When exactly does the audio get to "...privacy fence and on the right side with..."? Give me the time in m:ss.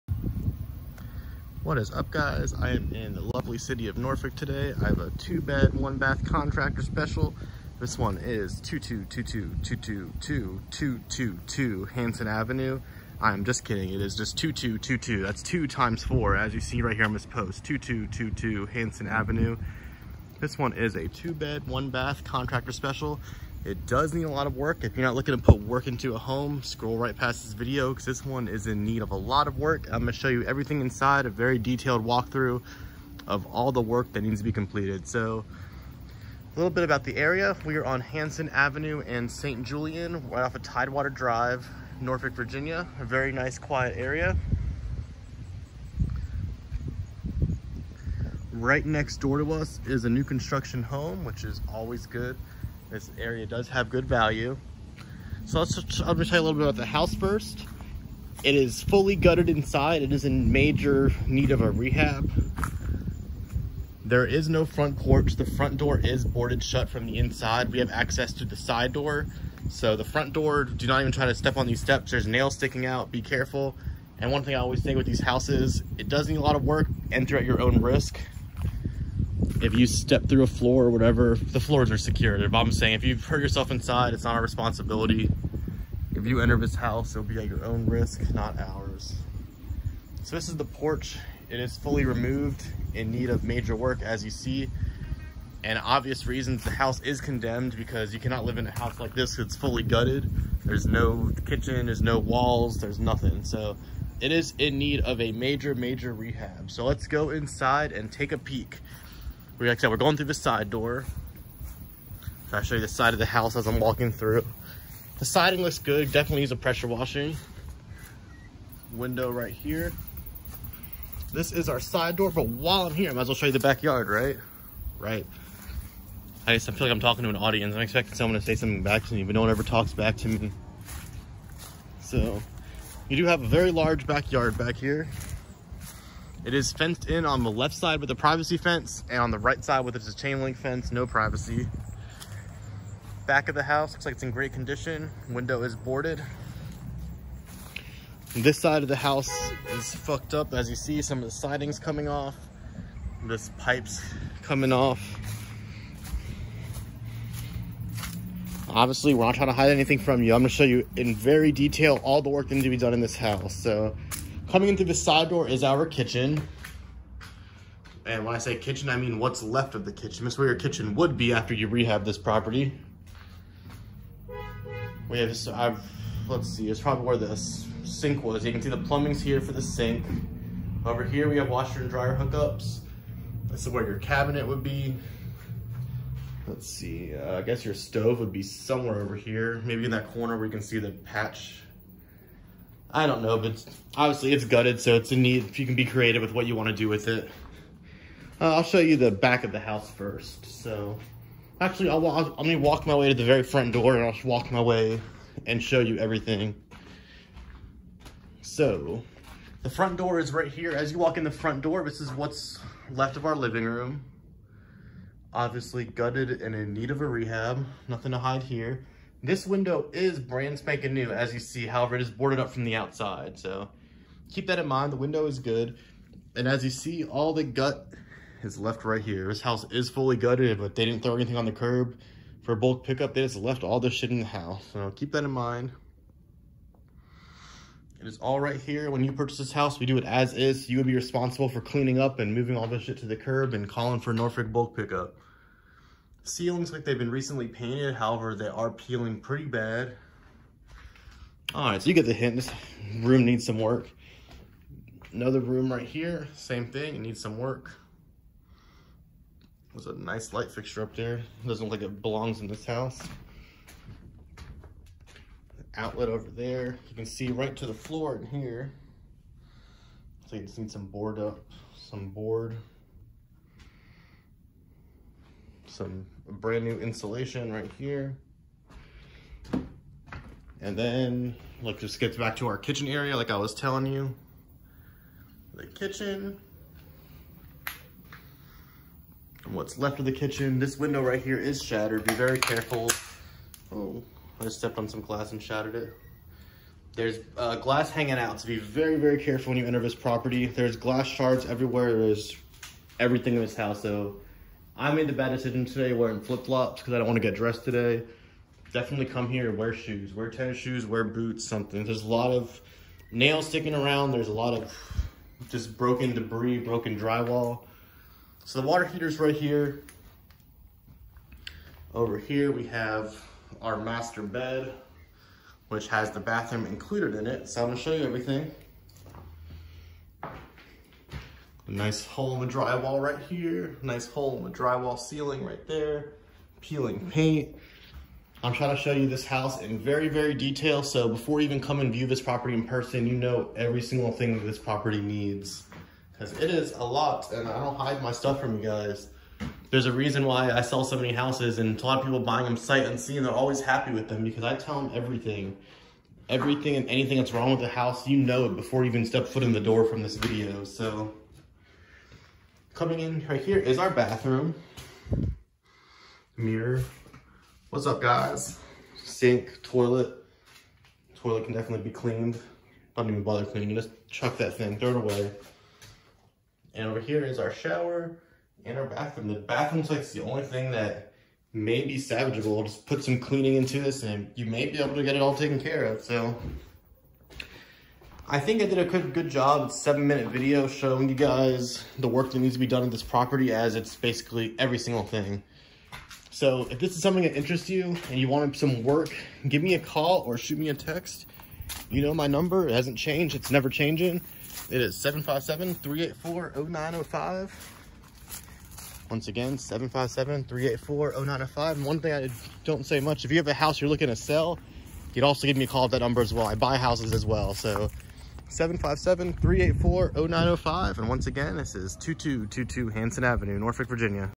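2:18.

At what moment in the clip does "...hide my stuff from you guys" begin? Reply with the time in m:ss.
5:47.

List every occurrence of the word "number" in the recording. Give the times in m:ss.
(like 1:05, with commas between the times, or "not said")
6:42, 6:55.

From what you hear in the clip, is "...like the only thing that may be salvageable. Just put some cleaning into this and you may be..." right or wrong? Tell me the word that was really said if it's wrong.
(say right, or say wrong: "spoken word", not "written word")
right.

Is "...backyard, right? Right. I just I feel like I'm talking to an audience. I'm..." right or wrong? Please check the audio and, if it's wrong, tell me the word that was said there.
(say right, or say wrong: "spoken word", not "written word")
right.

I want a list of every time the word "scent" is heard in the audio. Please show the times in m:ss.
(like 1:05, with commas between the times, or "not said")
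not said.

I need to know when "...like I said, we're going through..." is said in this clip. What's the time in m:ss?
1:49.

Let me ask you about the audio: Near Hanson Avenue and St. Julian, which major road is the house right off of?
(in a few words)
Tidewater Drive.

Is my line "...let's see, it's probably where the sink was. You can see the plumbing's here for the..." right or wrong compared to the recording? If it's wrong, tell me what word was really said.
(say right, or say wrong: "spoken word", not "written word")
right.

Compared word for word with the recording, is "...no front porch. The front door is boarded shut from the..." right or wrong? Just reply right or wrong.
right.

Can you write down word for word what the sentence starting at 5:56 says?
Everything and anything that's wrong with the house, you know it before you even step foot in the door from this video.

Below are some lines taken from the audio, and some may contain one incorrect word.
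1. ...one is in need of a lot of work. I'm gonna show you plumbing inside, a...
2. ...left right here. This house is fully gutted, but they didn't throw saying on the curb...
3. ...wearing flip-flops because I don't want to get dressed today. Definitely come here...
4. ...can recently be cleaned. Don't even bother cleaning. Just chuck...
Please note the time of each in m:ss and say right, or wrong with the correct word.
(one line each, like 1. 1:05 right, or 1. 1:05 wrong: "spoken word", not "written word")
1. 0:28 wrong: "everything", not "plumbing"
2. 3:48 wrong: "anything", not "saying"
3. 5:05 right
4. 6:11 wrong: "definitely", not "recently".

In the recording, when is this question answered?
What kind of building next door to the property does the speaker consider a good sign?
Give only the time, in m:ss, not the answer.
0:50.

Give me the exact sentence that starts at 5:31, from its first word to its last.
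A nice hole in the drywall right here.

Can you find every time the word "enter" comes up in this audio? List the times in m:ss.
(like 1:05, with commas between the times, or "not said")
1:17, 1:26, 4:59.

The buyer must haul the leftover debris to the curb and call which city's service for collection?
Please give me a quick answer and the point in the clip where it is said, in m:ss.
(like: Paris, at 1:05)
Norfolk bulk pickup, at 4:04.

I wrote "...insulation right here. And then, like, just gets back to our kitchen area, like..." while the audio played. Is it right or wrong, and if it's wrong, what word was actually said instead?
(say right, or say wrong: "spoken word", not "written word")
right.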